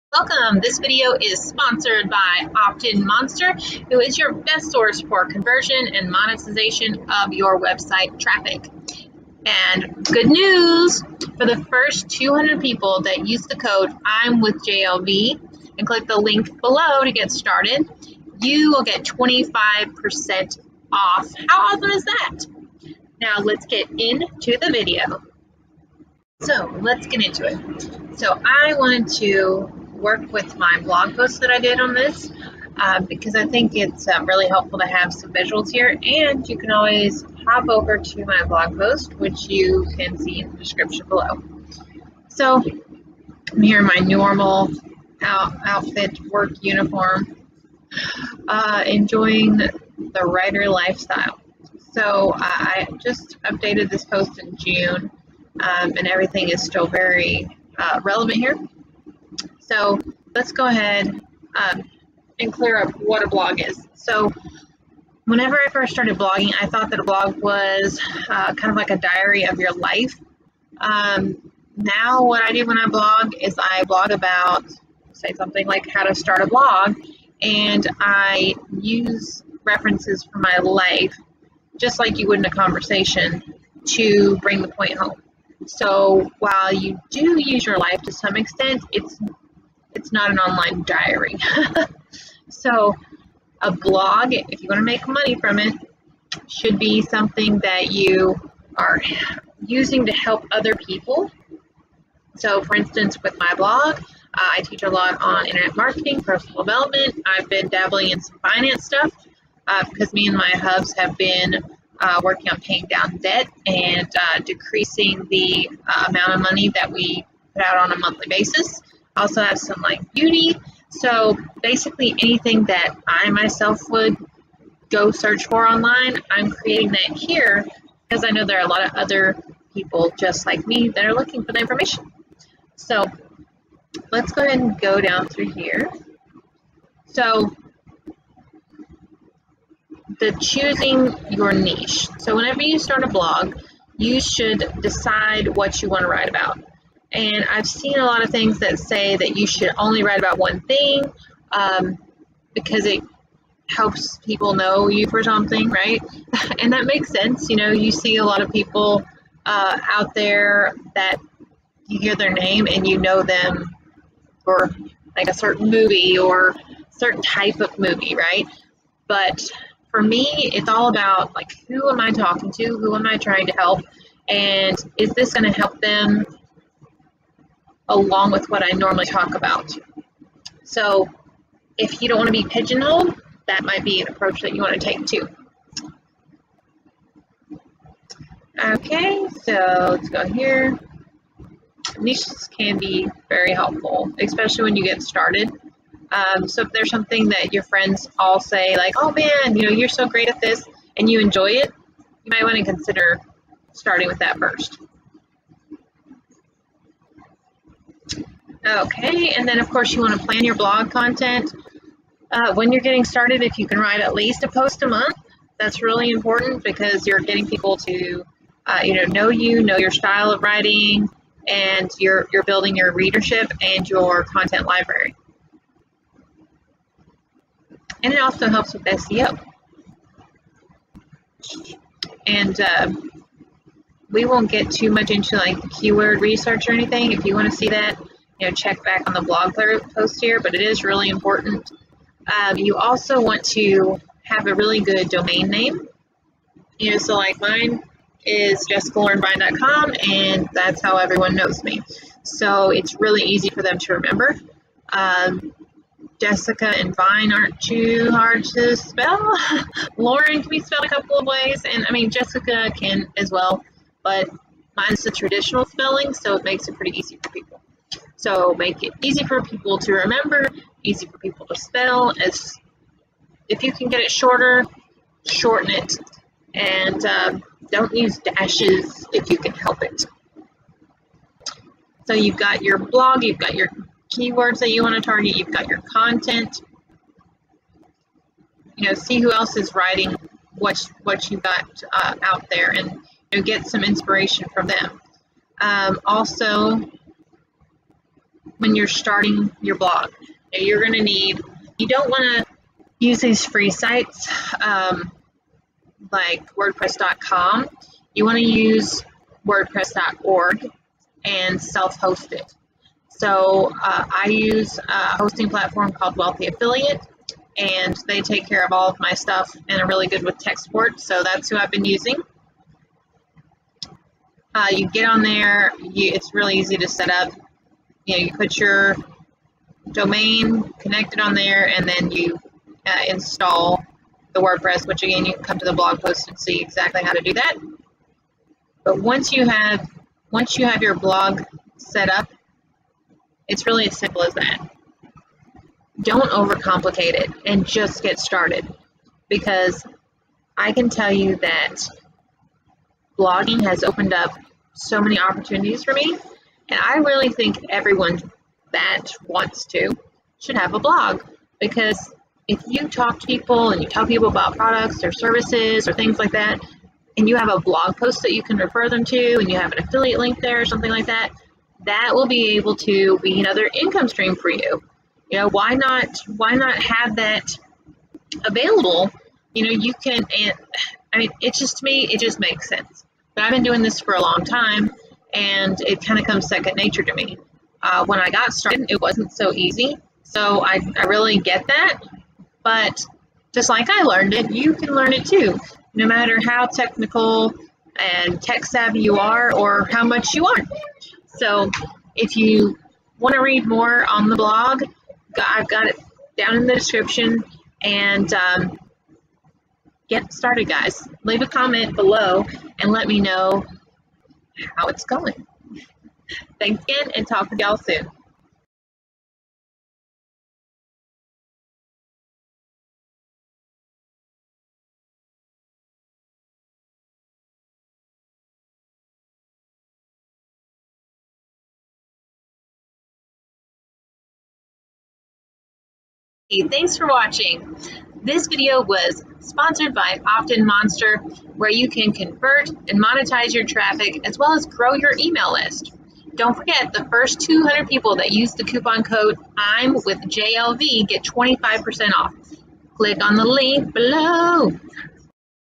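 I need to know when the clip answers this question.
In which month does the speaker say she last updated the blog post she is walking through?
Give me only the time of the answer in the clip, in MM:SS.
00:54.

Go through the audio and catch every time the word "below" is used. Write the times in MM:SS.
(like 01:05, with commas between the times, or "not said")
00:16, 00:41, 06:51, 07:33.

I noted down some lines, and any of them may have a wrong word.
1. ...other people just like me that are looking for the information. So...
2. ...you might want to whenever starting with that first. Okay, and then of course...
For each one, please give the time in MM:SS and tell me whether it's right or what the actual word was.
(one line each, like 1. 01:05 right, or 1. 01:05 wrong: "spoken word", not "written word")
1. 02:08 right
2. 03:22 wrong: "consider", not "whenever".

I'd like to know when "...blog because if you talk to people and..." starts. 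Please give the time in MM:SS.
06:00.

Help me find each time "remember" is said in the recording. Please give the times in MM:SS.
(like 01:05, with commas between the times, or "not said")
04:13, 04:29.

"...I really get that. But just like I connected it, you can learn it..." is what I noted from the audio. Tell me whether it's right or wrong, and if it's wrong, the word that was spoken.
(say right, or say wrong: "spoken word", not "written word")
wrong: "learned", not "connected".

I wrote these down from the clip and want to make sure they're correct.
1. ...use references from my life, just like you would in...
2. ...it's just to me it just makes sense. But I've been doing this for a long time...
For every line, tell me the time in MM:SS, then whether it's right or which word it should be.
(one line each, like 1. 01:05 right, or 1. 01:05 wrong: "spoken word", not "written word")
1. 01:18 right
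2. 06:21 right.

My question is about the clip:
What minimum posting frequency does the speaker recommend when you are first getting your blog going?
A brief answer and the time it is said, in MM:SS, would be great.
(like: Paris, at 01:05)
A post a month, at 03:34.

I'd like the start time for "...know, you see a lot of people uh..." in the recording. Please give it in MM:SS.
02:37.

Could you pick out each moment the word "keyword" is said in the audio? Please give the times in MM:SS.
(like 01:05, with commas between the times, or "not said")
03:55, 04:44.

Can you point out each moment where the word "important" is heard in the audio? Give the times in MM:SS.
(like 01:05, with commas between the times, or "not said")
03:36, 04:01.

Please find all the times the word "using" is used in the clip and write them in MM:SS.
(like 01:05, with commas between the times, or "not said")
01:39, 05:21.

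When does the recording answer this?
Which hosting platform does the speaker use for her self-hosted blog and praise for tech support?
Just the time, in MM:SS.
05:16.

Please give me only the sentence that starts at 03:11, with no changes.
Niches can be very helpful, especially when you get started.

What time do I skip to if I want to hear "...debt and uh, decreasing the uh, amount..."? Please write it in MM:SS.
01:53.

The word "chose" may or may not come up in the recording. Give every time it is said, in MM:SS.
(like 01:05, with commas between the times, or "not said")
not said.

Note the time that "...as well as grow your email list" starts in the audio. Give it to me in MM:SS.
07:24.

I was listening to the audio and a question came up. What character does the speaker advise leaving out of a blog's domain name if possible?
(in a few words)
Dashes.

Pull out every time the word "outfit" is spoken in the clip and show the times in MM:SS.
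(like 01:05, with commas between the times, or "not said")
00:45.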